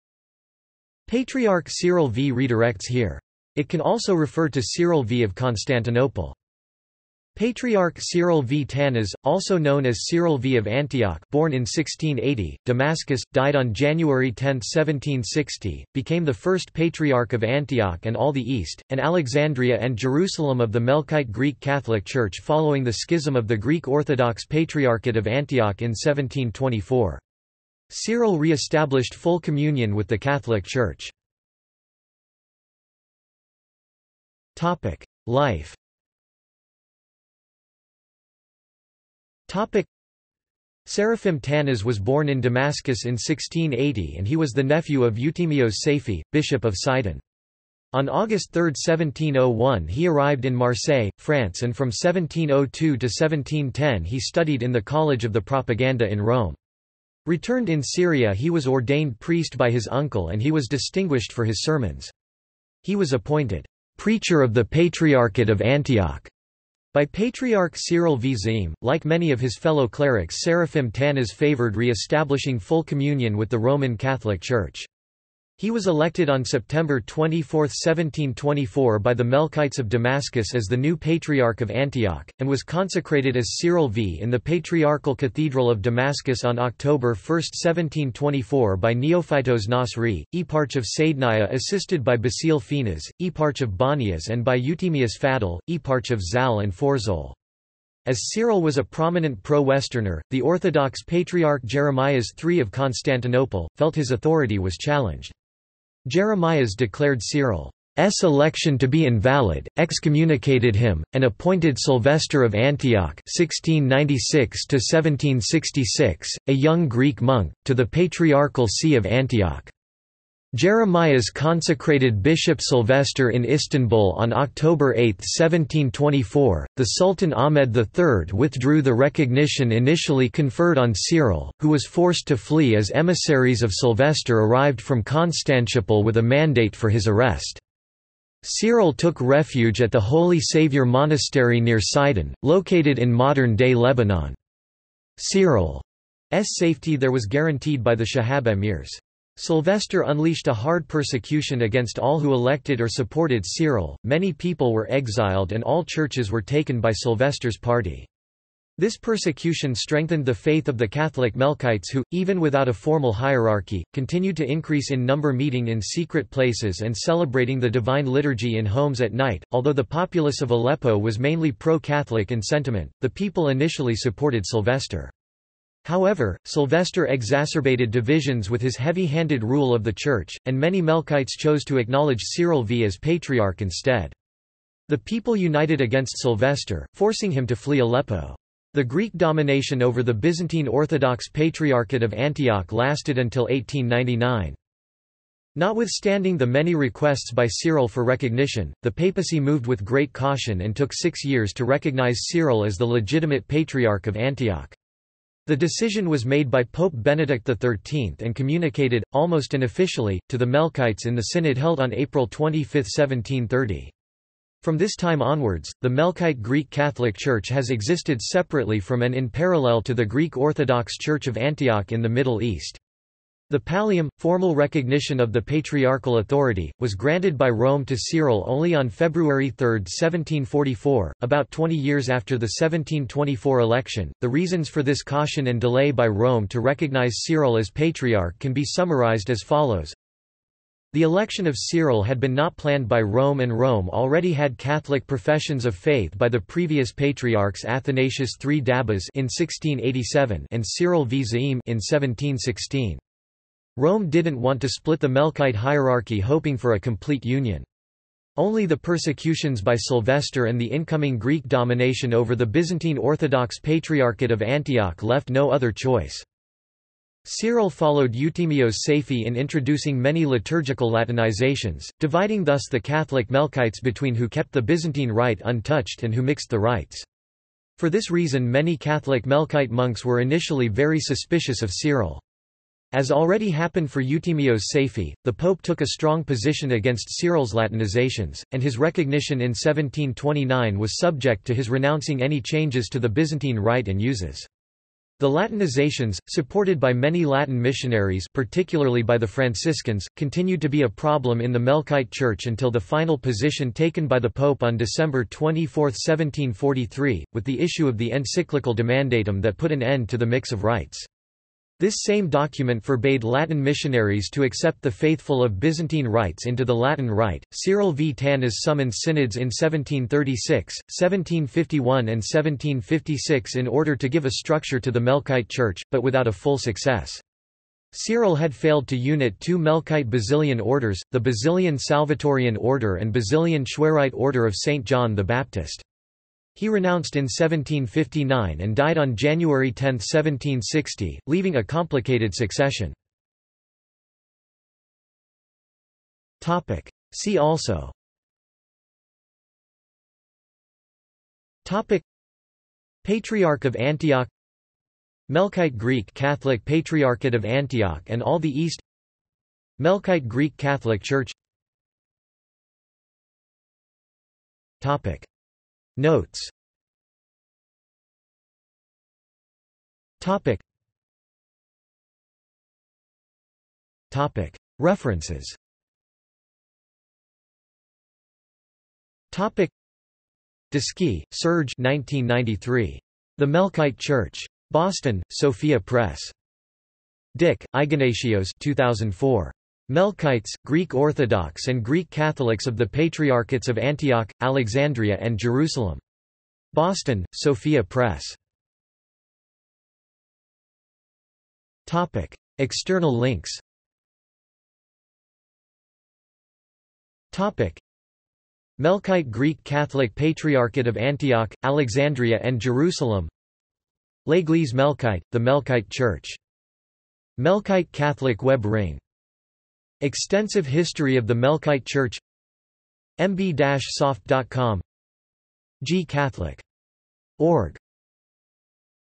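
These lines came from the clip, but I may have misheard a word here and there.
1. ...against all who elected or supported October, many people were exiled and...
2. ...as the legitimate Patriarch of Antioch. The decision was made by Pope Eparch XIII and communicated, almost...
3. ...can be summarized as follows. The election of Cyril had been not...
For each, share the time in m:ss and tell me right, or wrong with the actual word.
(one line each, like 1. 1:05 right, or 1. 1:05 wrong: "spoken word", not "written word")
1. 2:31 wrong: "Cyril", not "October"
2. 3:22 wrong: "Benedict", not "Eparch"
3. 3:58 right.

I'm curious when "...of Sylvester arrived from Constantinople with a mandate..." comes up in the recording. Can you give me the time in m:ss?
2:13.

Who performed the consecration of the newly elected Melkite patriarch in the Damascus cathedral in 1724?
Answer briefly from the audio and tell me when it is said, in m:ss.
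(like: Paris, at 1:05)
Neophytos Nasri, at 1:28.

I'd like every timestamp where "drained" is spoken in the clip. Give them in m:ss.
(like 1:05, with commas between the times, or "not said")
not said.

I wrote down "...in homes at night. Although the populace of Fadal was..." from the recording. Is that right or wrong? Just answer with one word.
wrong.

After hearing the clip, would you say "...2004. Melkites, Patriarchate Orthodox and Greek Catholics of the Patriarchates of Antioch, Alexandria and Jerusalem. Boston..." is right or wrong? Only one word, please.
wrong.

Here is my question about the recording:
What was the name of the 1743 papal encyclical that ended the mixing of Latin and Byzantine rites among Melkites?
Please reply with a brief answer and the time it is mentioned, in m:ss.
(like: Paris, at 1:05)
Demandatum, at 5:08.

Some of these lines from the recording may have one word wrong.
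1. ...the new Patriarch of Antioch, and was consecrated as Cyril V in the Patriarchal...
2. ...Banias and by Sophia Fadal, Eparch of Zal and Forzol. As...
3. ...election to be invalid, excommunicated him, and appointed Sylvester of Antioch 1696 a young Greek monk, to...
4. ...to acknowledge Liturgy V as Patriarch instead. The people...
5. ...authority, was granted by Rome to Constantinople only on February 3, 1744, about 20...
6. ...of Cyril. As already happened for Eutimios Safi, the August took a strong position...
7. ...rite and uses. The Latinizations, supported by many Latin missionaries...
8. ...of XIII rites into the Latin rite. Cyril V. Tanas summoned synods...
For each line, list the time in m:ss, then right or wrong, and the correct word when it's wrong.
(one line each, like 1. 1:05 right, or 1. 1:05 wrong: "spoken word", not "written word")
1. 1:20 right
2. 1:33 wrong: "Eutemius", not "Sophia"
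3. 1:48 right
4. 3:01 wrong: "Cyril", not "Liturgy"
5. 3:46 wrong: "Cyril", not "Constantinople"
6. 4:41 wrong: "Pope", not "August"
7. 4:53 right
8. 5:15 wrong: "Byzantine", not "XIII".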